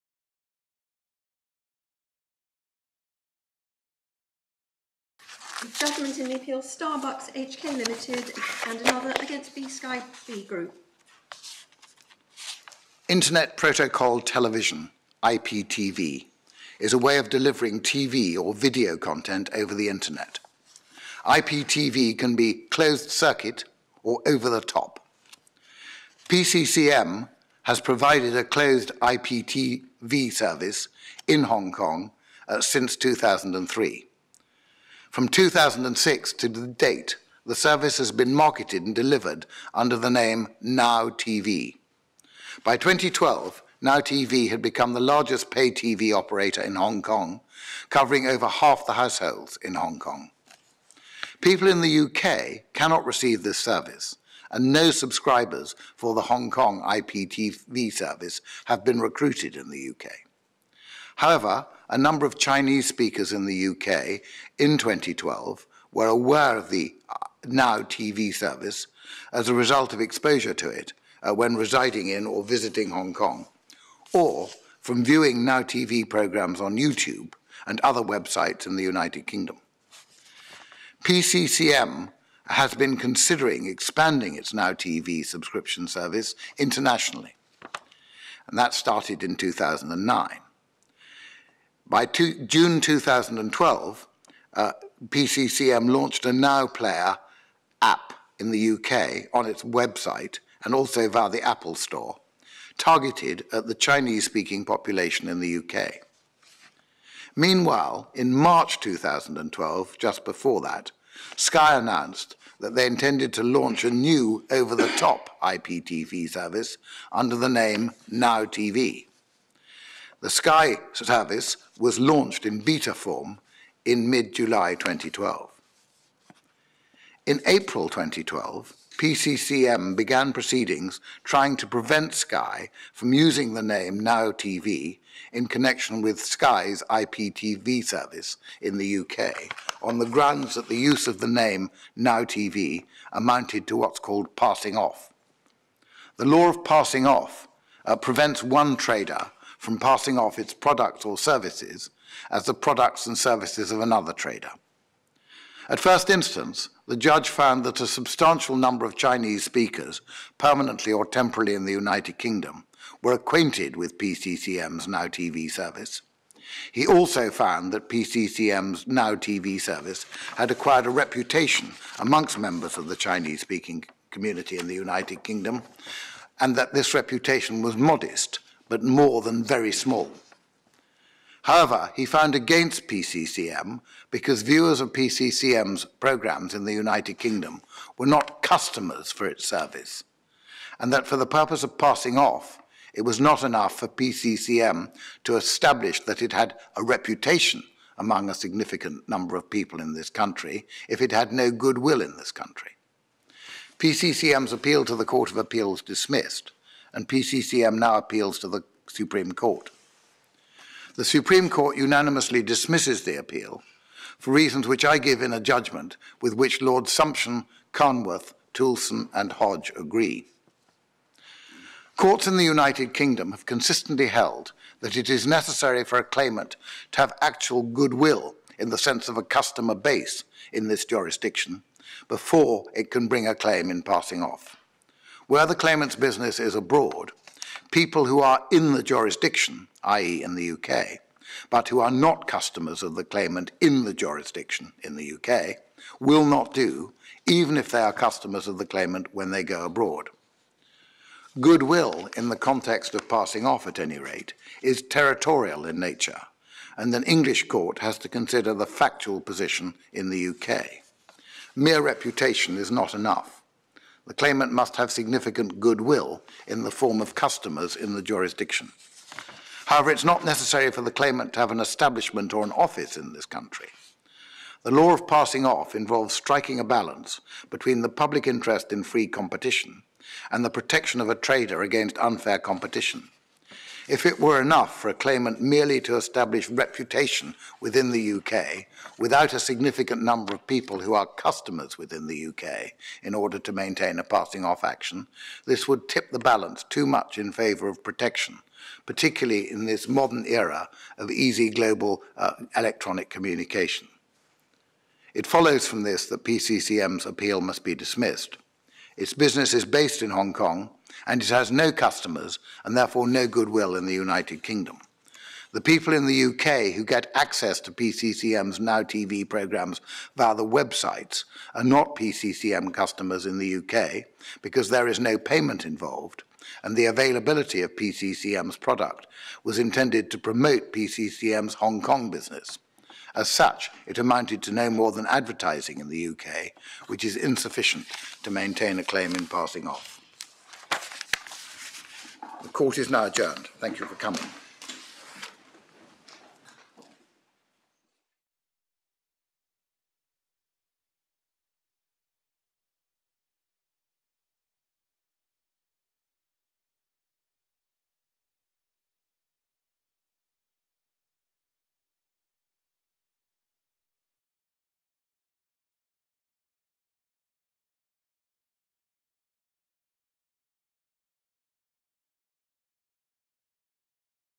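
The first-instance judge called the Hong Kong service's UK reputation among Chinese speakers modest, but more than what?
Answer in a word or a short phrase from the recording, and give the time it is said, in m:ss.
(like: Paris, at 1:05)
very small, at 2:59.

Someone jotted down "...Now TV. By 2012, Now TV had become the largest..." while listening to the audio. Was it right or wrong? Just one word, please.
right.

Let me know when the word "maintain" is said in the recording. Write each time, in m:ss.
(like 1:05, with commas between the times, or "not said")
4:53, 5:38.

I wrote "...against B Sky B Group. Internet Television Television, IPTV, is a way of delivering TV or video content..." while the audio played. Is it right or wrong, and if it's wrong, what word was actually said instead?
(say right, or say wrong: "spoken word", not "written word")
wrong: "Protocol", not "Television".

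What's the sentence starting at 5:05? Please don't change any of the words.
It follows from this that PCCM's appeal must be dismissed.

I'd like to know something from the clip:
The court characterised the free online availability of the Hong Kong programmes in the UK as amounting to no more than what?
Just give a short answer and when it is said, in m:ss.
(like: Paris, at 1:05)
advertising, at 5:35.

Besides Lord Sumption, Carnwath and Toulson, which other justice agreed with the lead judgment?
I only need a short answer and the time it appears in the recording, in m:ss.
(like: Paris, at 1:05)
Hodge, at 3:39.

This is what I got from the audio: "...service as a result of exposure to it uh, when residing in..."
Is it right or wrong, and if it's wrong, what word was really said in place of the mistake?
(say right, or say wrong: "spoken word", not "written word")
right.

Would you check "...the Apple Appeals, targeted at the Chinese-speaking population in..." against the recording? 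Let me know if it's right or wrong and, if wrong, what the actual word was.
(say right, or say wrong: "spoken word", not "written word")
wrong: "Store", not "Appeals".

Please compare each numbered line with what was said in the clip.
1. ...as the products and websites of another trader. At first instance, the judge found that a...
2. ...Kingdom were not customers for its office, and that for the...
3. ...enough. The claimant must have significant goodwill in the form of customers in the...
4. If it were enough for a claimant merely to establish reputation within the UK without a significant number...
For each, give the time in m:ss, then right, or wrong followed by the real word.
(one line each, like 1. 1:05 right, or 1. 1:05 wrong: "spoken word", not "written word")
1. 2:32 wrong: "services", not "websites"
2. 3:07 wrong: "service", not "office"
3. 4:22 right
4. 4:43 right.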